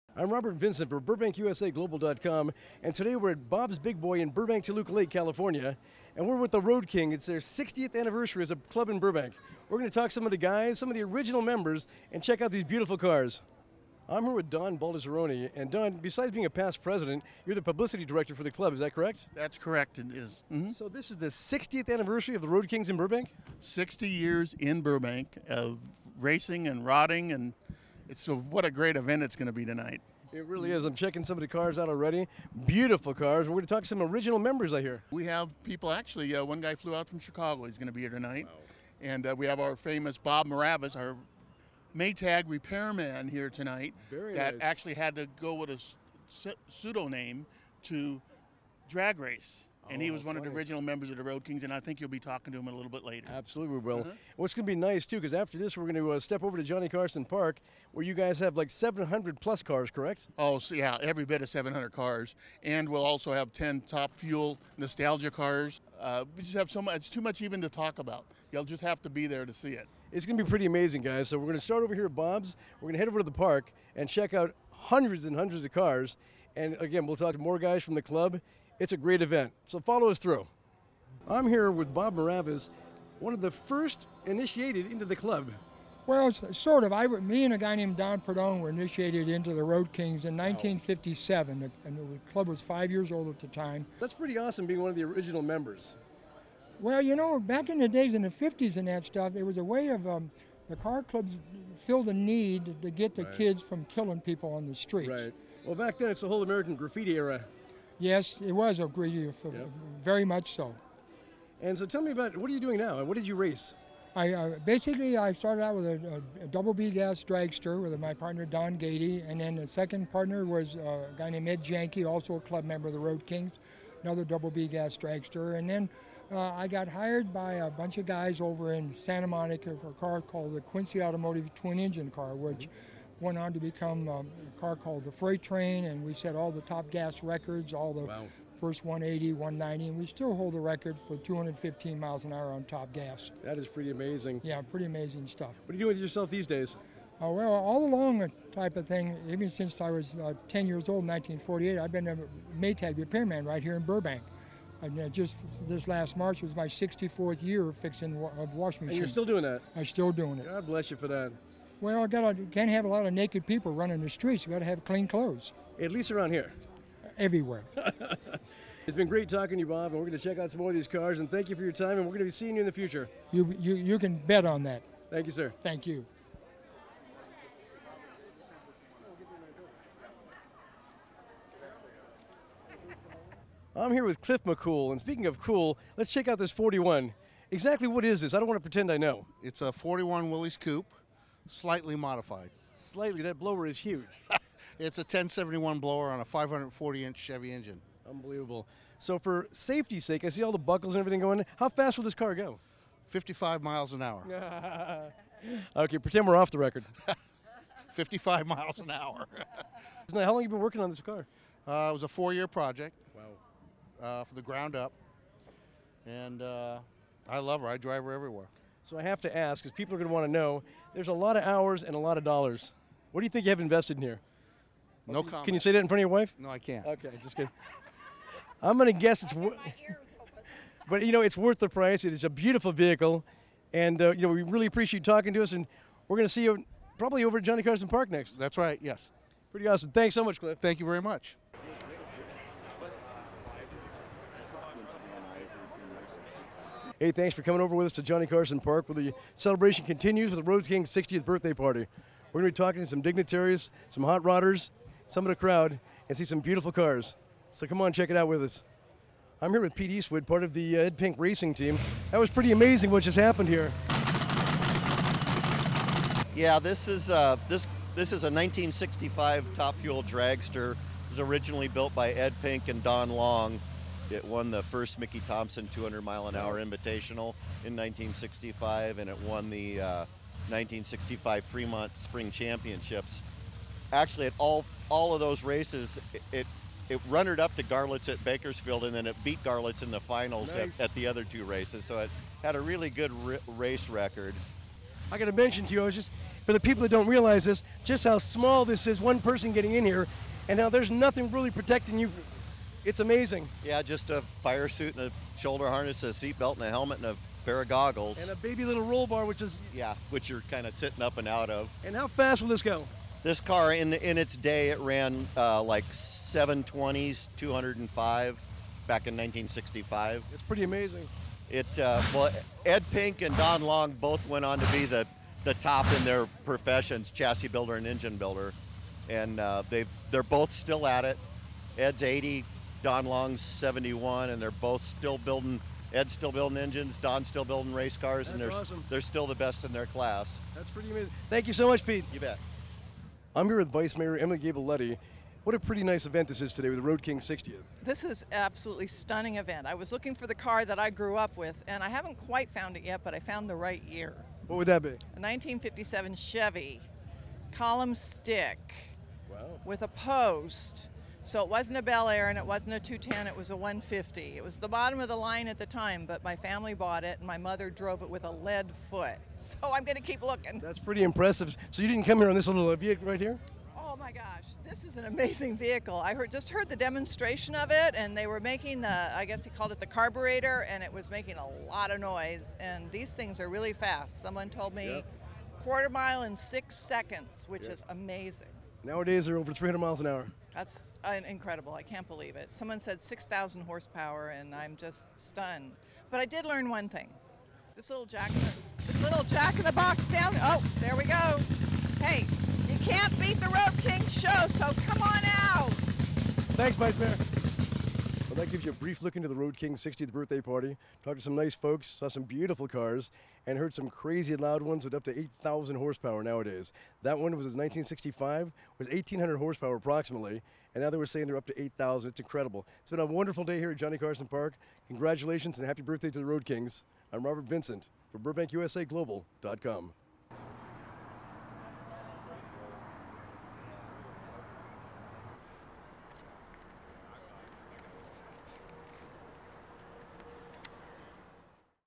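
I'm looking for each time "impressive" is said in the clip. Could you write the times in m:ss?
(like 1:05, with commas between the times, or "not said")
6:11.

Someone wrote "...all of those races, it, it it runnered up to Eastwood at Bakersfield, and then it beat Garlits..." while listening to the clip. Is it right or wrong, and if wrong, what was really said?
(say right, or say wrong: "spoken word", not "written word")
wrong: "Garlits", not "Eastwood".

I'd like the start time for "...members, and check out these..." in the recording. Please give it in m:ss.
0:11.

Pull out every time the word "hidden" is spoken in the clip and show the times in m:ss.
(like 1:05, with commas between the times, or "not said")
not said.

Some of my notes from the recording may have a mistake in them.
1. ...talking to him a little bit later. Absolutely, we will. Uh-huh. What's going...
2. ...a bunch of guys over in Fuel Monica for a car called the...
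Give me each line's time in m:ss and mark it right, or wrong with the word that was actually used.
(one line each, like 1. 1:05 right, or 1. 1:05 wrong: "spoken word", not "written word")
1. 0:52 right
2. 2:07 wrong: "Santa", not "Fuel".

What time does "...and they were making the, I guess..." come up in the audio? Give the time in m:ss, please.
6:17.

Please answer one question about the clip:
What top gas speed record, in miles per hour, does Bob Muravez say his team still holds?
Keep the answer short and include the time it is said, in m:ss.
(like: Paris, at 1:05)
215, at 2:21.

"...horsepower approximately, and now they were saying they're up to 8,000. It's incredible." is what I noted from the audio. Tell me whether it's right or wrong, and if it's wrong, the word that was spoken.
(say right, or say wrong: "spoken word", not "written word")
right.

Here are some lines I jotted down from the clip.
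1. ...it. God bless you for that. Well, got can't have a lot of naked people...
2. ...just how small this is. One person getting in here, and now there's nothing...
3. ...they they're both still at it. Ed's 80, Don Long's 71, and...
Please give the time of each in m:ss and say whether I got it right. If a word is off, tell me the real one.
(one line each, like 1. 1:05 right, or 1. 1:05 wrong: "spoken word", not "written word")
1. 2:40 right
2. 4:57 right
3. 5:29 right.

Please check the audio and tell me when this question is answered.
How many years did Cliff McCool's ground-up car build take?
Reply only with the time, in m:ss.
3:32.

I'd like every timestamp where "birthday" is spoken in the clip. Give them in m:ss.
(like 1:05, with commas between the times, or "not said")
4:11, 6:50, 7:05.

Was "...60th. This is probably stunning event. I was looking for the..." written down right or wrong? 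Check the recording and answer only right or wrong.
wrong.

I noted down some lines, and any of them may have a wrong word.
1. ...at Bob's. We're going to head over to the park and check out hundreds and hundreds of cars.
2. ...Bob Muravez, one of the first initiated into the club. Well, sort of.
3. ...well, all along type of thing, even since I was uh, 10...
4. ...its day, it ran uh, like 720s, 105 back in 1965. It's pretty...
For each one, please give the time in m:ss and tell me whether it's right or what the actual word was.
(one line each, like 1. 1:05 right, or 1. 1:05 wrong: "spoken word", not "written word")
1. 1:12 right
2. 1:21 right
3. 2:27 right
4. 5:14 wrong: "205", not "105".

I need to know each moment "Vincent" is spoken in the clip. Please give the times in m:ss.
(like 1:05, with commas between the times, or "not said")
0:00, 7:07.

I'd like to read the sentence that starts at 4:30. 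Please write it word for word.
It was originally built by Ed Pink and Don Long.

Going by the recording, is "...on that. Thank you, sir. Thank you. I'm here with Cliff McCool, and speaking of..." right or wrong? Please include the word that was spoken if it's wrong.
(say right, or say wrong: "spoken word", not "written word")
right.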